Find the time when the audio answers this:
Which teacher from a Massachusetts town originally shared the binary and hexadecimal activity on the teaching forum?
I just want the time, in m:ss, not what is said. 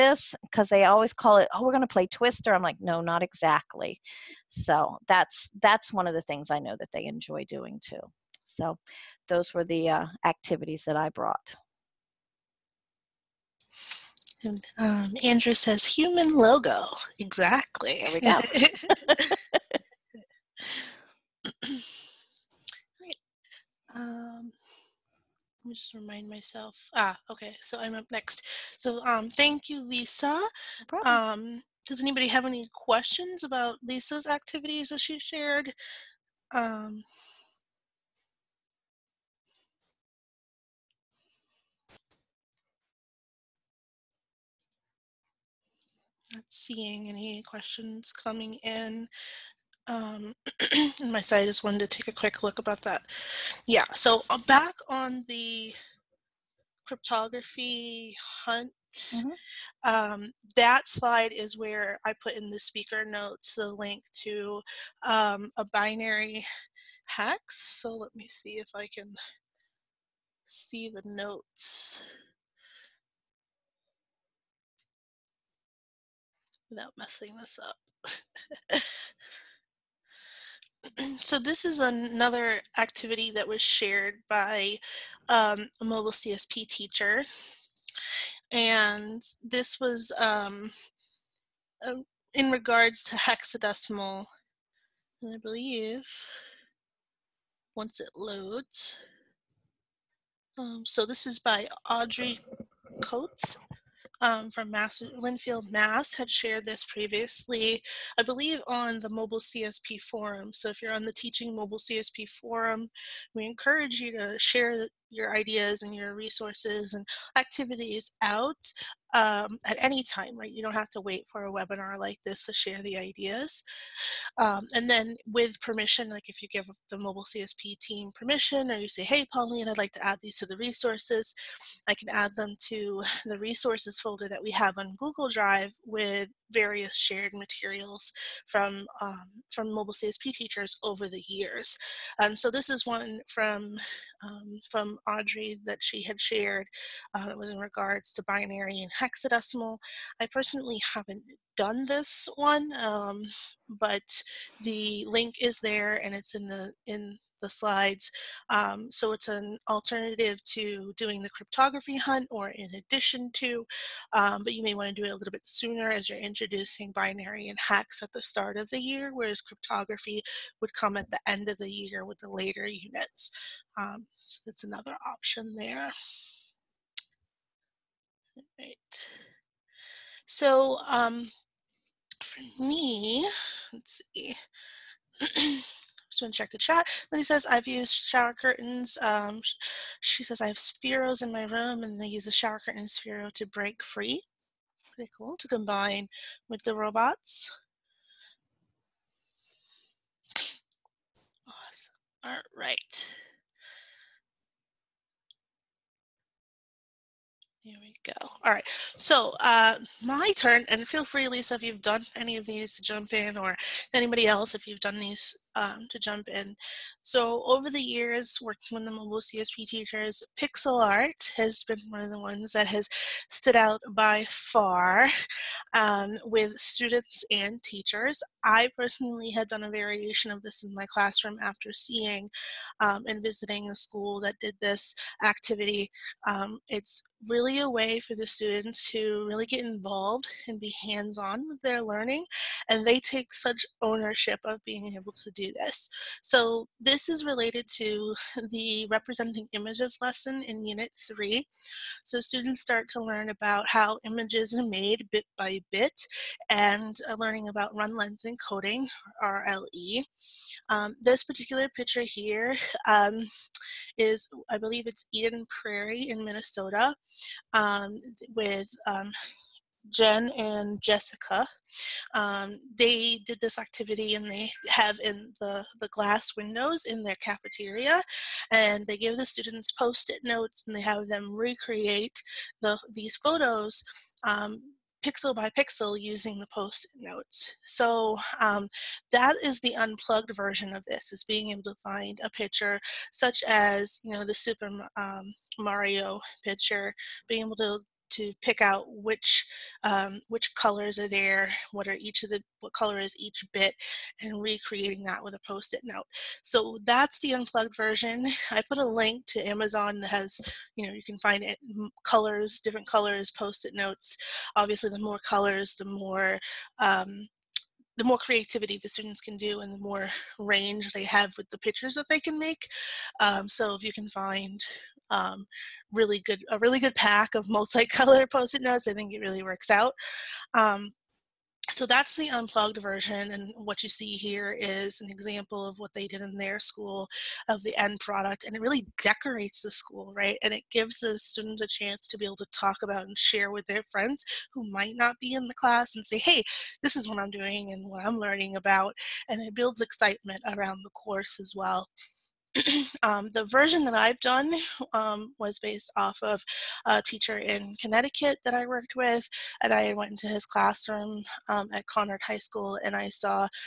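1:41.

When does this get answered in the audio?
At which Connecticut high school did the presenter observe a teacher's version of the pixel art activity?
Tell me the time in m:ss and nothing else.
6:01.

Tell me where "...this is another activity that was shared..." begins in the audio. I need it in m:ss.
1:21.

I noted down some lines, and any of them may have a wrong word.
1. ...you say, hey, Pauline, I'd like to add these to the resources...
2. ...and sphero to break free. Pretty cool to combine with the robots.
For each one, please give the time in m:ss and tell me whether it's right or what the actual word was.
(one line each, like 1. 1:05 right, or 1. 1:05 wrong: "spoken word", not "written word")
1. 2:08 right
2. 3:12 right.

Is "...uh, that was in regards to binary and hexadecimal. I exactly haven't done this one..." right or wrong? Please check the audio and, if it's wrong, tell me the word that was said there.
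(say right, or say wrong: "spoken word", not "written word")
wrong: "personally", not "exactly".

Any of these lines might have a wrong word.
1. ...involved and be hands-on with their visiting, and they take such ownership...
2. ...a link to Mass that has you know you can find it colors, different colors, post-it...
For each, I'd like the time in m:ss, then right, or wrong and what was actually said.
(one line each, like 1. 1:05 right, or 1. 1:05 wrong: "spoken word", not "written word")
1. 3:59 wrong: "learning", not "visiting"
2. 5:08 wrong: "Amazon", not "Mass".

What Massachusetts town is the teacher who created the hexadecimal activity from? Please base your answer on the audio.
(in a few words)
Lynnfield.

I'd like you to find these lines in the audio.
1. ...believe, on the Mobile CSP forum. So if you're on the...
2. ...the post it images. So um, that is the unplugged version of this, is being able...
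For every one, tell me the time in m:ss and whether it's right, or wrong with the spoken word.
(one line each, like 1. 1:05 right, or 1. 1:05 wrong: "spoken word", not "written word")
1. 1:48 right
2. 4:46 wrong: "notes", not "images".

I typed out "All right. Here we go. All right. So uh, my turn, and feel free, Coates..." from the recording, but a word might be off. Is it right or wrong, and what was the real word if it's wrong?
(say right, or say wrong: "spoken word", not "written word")
wrong: "Lisa", not "Coates".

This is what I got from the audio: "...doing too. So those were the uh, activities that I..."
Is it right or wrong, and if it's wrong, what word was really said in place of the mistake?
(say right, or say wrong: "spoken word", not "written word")
right.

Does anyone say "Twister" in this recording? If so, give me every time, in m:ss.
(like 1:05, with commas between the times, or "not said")
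0:02.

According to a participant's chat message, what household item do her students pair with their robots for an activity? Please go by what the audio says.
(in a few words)
shower curtains.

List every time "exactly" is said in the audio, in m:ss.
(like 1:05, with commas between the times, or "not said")
0:03, 0:17.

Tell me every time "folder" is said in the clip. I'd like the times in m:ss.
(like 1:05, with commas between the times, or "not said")
2:14.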